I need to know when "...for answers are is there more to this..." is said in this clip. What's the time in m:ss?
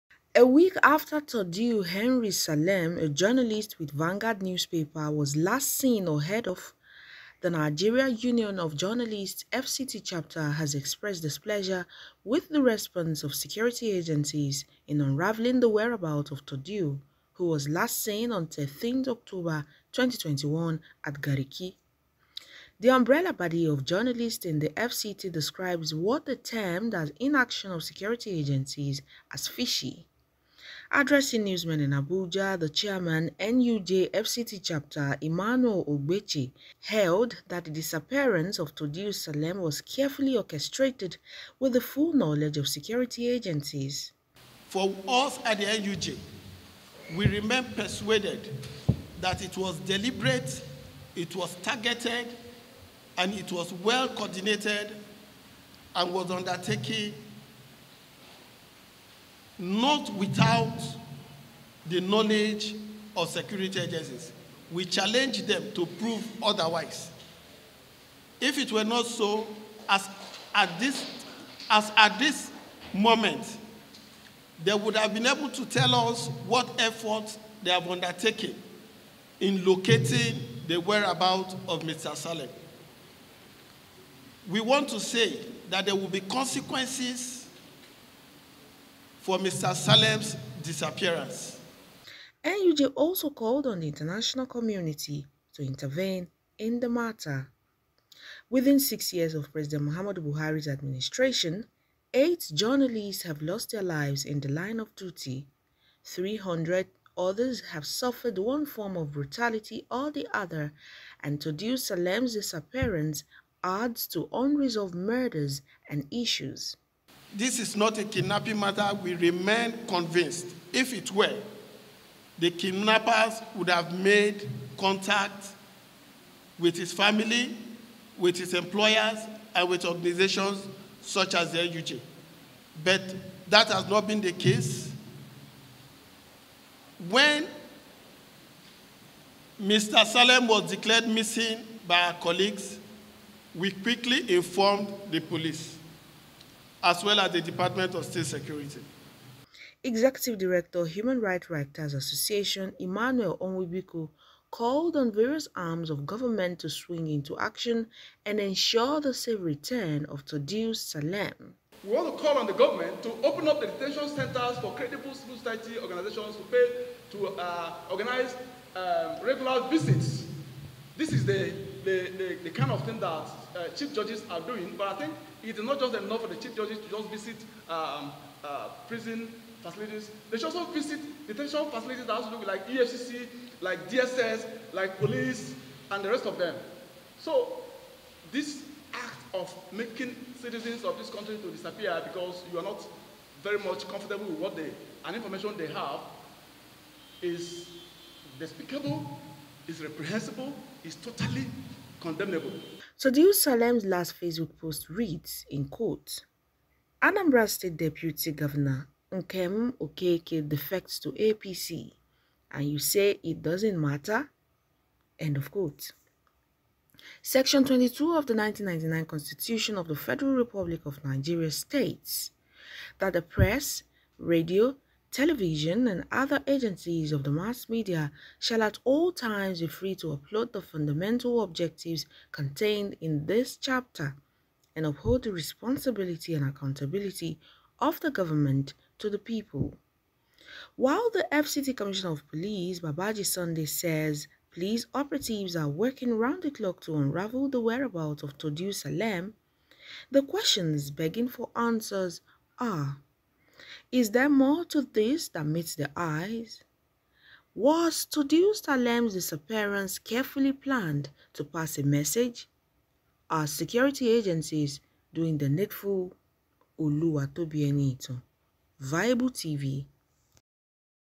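4:11.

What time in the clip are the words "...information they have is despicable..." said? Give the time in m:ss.
3:15.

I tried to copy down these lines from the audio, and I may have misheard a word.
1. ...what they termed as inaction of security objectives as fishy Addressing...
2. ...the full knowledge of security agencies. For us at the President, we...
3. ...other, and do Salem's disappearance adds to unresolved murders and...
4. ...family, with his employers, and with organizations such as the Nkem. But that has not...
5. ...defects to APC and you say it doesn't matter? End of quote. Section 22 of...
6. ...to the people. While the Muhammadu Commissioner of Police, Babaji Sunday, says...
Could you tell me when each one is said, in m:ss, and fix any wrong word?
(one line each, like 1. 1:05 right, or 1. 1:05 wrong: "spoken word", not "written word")
1. 0:25 wrong: "agencies", not "objectives"
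2. 0:41 wrong: "NUJ", not "President"
3. 1:50 right
4. 2:06 wrong: "NUJ", not "Nkem"
5. 3:30 right
6. 3:58 wrong: "FCT", not "Muhammadu".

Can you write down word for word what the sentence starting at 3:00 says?
They should also visit detention facilities that also look like EFCC, like DSS, like police, and the rest of them.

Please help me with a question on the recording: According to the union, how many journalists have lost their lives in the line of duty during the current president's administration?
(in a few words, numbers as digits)
8.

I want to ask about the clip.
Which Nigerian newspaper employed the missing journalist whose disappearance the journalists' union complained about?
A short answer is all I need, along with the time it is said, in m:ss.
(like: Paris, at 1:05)
Vanguard, at 0:03.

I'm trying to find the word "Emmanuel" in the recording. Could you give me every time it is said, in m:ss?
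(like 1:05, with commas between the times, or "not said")
0:35, 2:32.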